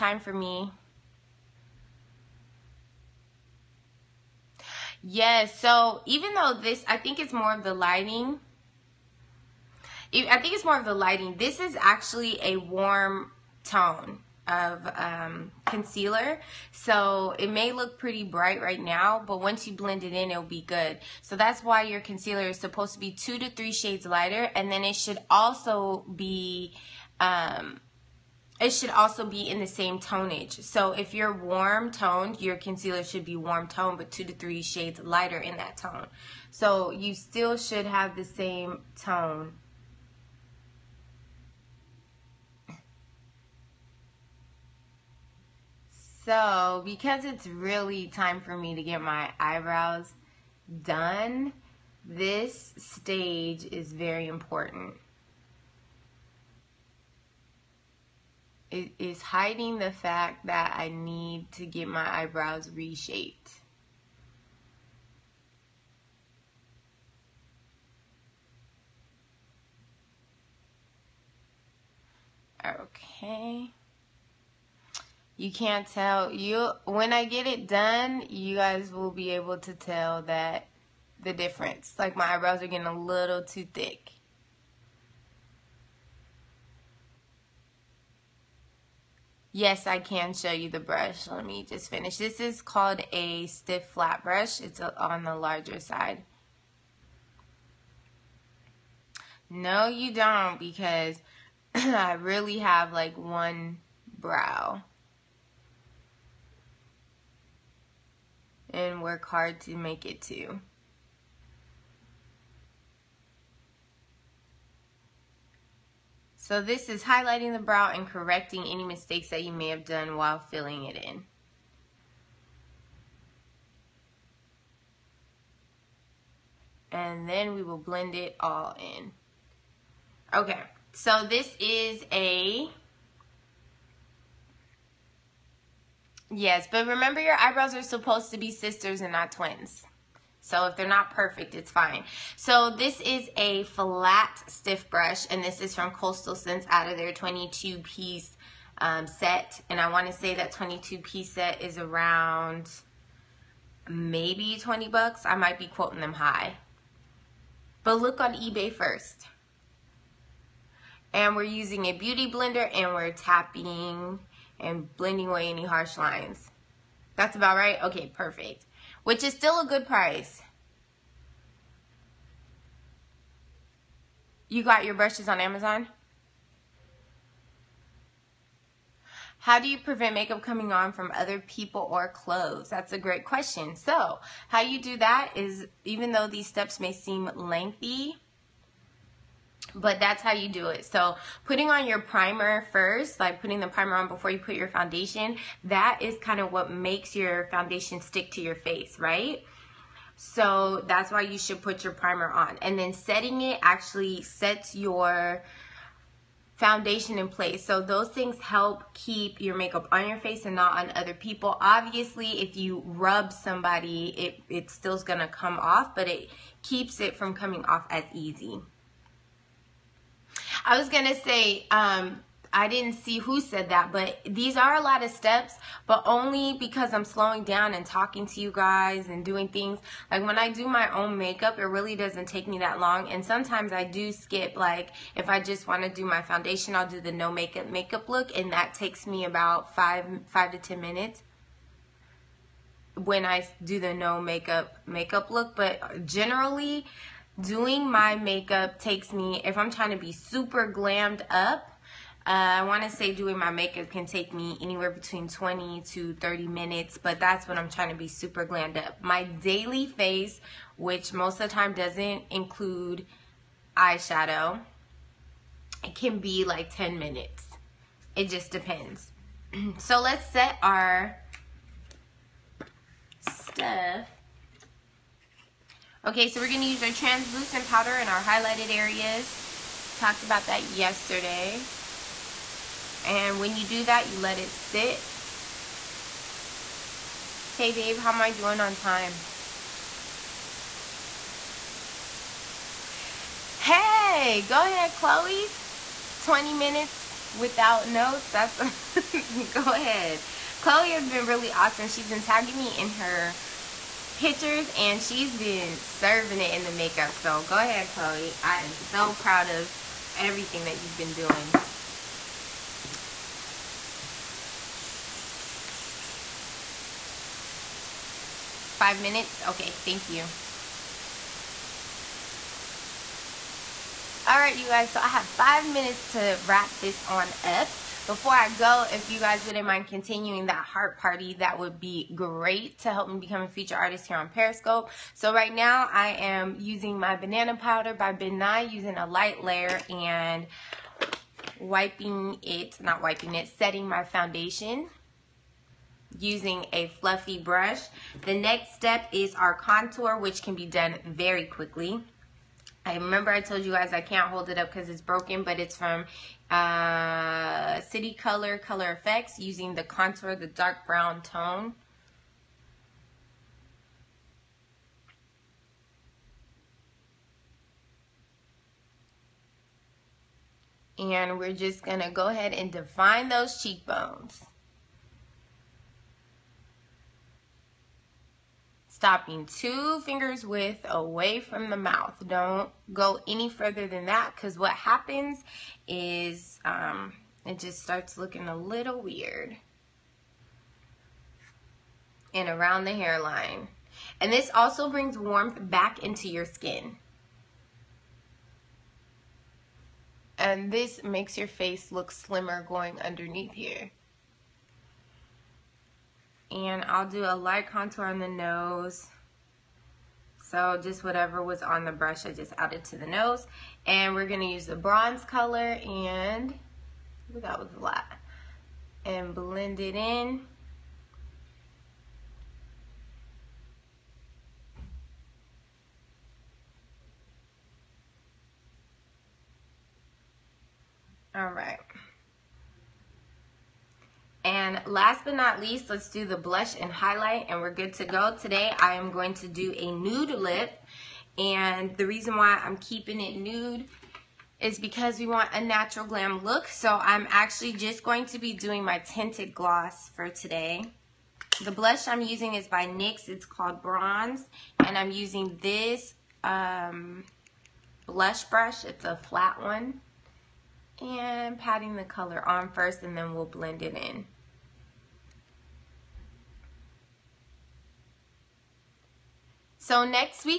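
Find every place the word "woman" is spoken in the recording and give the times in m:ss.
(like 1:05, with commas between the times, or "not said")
not said.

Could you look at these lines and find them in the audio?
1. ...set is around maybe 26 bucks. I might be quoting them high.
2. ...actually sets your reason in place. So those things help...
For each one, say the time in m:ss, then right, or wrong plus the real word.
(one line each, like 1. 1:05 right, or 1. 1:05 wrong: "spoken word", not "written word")
1. 2:31 wrong: "20", not "26"
2. 3:23 wrong: "foundation", not "reason".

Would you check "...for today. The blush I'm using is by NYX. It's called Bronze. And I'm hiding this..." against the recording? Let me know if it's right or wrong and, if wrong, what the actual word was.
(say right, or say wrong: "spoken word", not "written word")
wrong: "using", not "hiding".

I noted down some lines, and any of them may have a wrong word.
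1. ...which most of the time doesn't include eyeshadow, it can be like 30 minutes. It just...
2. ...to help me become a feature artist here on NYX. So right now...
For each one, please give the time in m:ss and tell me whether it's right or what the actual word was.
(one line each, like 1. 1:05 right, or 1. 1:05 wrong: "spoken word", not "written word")
1. 4:20 wrong: "10", not "30"
2. 5:32 wrong: "Periscope", not "NYX".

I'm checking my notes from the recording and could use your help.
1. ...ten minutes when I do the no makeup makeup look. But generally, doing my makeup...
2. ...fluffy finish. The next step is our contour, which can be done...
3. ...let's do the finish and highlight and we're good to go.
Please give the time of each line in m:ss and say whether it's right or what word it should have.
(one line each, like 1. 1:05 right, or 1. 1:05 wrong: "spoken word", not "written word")
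1. 4:00 right
2. 5:46 wrong: "brush", not "finish"
3. 7:15 wrong: "blush", not "finish".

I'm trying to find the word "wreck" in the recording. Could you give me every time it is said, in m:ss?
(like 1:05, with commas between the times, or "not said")
not said.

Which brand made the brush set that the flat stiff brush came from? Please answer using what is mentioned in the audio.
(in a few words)
Coastal Scents.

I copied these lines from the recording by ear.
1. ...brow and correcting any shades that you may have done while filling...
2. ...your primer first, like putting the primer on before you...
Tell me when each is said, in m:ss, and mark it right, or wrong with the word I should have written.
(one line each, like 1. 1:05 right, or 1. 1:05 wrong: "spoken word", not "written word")
1. 1:57 wrong: "mistakes", not "shades"
2. 3:11 right.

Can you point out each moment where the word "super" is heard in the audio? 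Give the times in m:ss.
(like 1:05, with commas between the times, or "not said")
4:10, 4:18.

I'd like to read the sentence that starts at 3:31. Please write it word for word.
Obviously, if you rub somebody, it, it's still gonna come off, but it keeps it from coming off as easy.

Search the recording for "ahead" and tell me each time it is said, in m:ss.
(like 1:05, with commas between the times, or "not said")
4:54, 4:59, 5:07, 6:12.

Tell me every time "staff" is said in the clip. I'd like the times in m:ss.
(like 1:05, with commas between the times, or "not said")
not said.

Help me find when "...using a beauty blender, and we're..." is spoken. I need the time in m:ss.
2:41.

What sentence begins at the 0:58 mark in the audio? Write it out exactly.
It is hiding the fact that I need to get my eyebrows reshaped.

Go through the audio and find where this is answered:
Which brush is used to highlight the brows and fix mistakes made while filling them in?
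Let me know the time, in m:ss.
1:33.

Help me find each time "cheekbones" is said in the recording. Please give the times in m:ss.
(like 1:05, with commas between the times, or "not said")
6:13.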